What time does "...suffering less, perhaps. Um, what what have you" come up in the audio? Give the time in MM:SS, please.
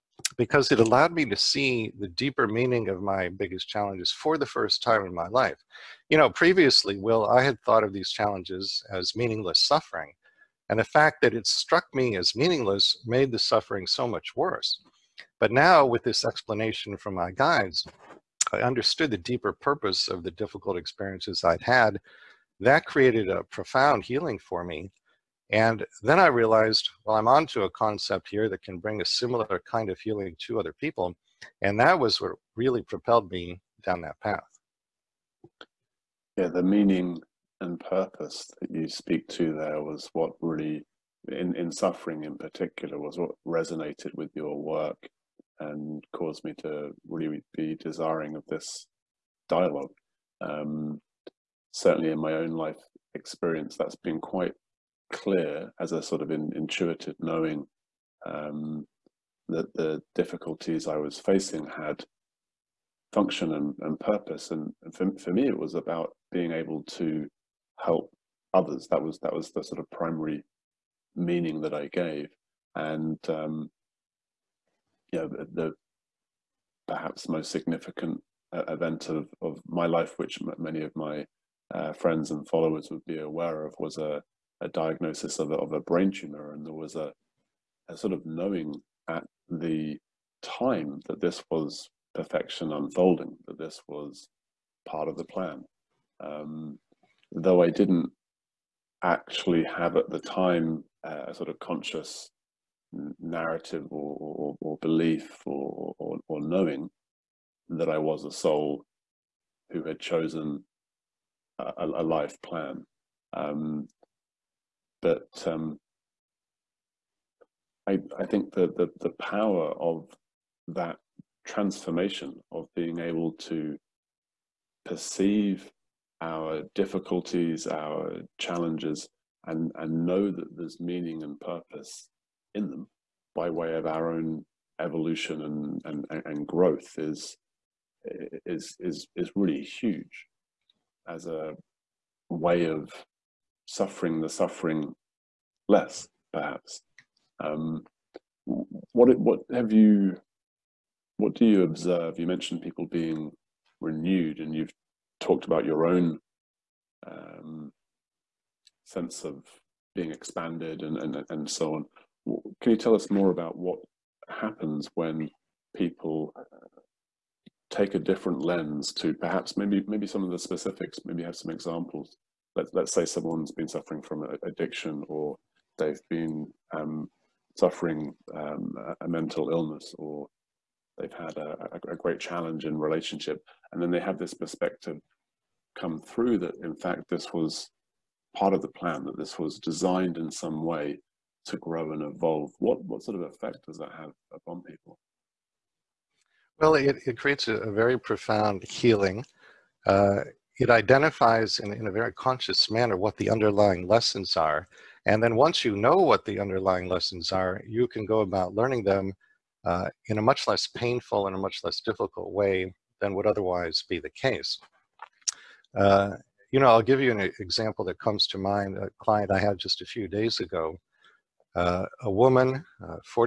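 02:24.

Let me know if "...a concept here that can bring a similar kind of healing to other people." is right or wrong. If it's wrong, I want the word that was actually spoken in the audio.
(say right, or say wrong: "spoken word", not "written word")
right.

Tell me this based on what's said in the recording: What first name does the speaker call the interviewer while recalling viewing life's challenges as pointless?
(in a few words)
Will.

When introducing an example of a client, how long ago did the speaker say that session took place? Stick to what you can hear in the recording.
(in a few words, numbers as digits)
A few days ago.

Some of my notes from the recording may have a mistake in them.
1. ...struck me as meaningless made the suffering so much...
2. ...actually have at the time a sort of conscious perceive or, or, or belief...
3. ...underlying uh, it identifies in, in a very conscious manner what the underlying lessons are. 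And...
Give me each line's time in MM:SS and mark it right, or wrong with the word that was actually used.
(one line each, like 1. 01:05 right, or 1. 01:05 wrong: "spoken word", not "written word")
1. 00:11 right
2. 01:39 wrong: "narrative", not "perceive"
3. 03:18 wrong: "healing", not "underlying".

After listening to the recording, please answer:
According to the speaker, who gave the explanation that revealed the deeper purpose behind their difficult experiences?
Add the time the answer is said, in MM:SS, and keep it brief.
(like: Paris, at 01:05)
My guides, at 00:17.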